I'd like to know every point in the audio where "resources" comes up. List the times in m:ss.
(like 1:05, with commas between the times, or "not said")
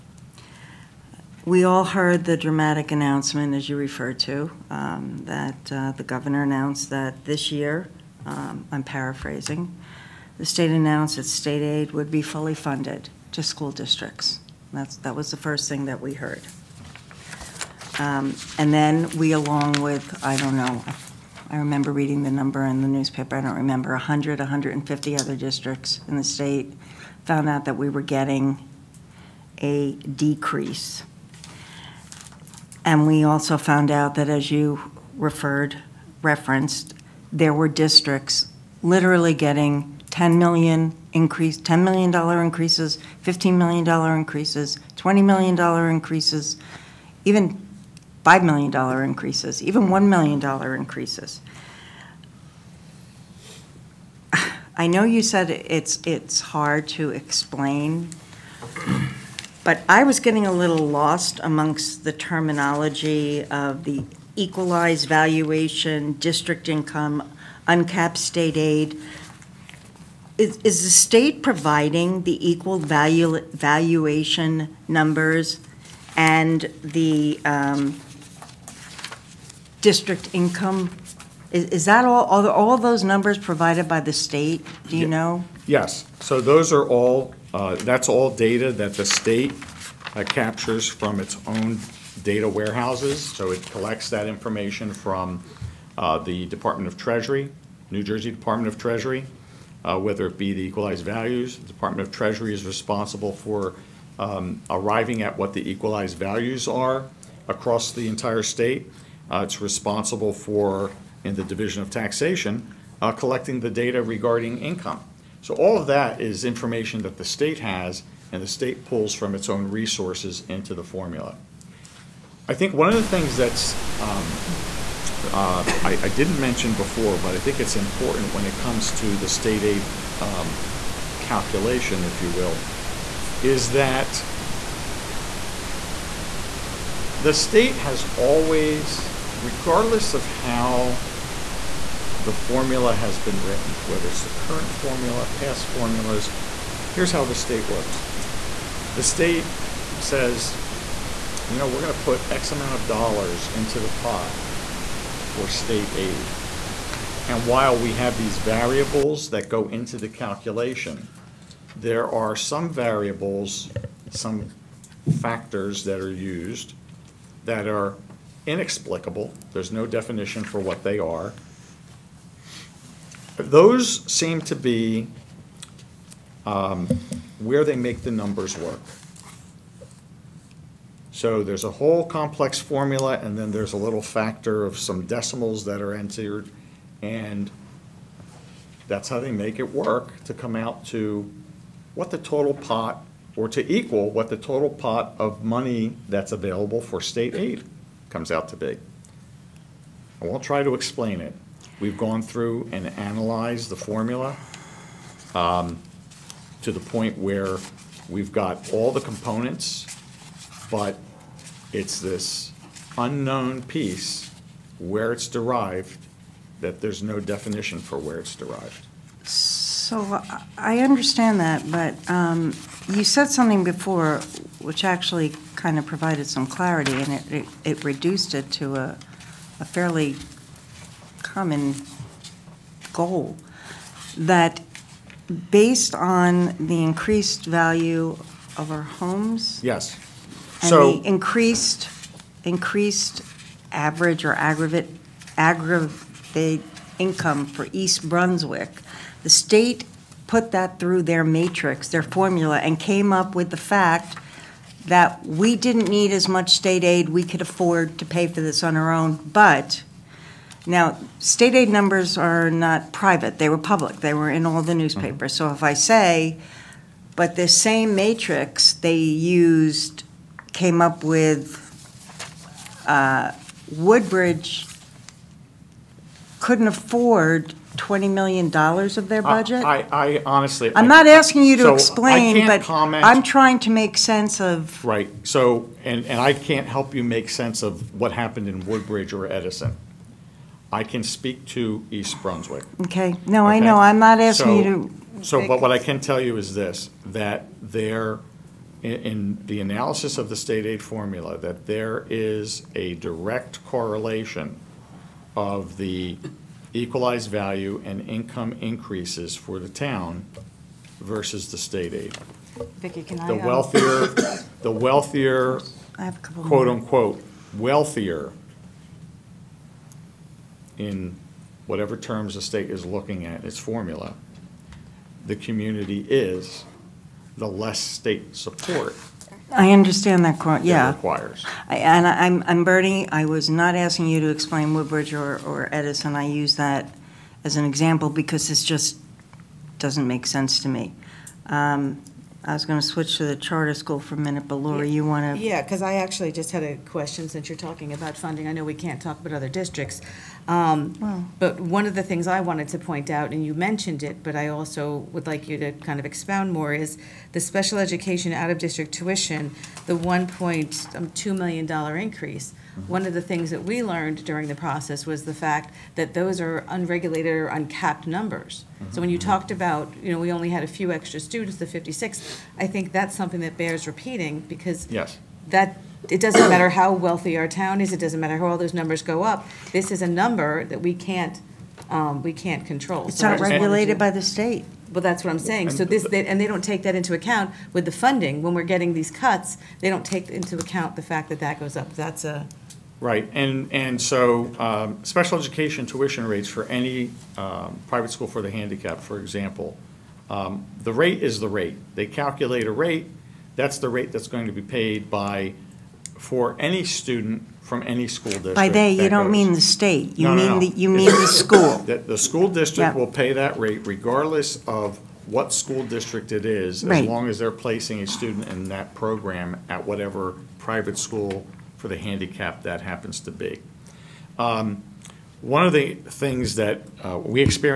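1:59.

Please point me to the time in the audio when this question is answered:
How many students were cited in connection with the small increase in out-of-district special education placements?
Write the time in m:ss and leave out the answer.
6:11.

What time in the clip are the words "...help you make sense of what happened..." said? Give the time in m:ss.
4:46.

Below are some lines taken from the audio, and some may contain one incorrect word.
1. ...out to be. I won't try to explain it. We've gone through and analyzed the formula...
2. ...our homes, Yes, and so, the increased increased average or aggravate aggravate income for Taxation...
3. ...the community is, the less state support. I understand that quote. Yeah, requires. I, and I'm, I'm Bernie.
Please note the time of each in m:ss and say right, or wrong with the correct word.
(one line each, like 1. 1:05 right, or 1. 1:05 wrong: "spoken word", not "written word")
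1. 3:18 right
2. 3:58 wrong: "East", not "Taxation"
3. 5:25 right.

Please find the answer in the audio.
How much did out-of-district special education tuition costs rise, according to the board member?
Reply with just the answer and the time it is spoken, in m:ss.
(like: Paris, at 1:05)
$1.2 million, at 6:00.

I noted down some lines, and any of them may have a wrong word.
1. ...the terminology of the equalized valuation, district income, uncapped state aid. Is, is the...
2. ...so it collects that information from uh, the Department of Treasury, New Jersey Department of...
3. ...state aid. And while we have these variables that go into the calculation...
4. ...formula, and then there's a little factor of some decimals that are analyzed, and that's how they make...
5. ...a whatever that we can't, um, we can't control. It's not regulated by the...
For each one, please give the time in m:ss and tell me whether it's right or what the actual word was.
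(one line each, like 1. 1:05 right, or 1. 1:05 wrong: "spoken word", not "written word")
1. 1:02 right
2. 1:33 right
3. 2:35 right
4. 3:02 wrong: "entered", not "analyzed"
5. 6:20 wrong: "number", not "whatever".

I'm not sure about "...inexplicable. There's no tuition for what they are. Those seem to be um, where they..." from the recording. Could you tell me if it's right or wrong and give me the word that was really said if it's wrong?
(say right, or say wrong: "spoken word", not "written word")
wrong: "definition", not "tuition".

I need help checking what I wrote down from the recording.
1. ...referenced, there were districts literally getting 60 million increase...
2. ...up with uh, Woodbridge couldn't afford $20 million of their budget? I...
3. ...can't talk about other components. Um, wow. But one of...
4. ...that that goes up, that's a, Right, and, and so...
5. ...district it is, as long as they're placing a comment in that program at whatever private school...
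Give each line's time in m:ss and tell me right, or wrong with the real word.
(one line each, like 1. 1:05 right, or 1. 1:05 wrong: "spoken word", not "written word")
1. 0:36 wrong: "10", not "60"
2. 4:30 right
3. 5:48 wrong: "districts", not "components"
4. 6:31 right
5. 6:55 wrong: "student", not "comment".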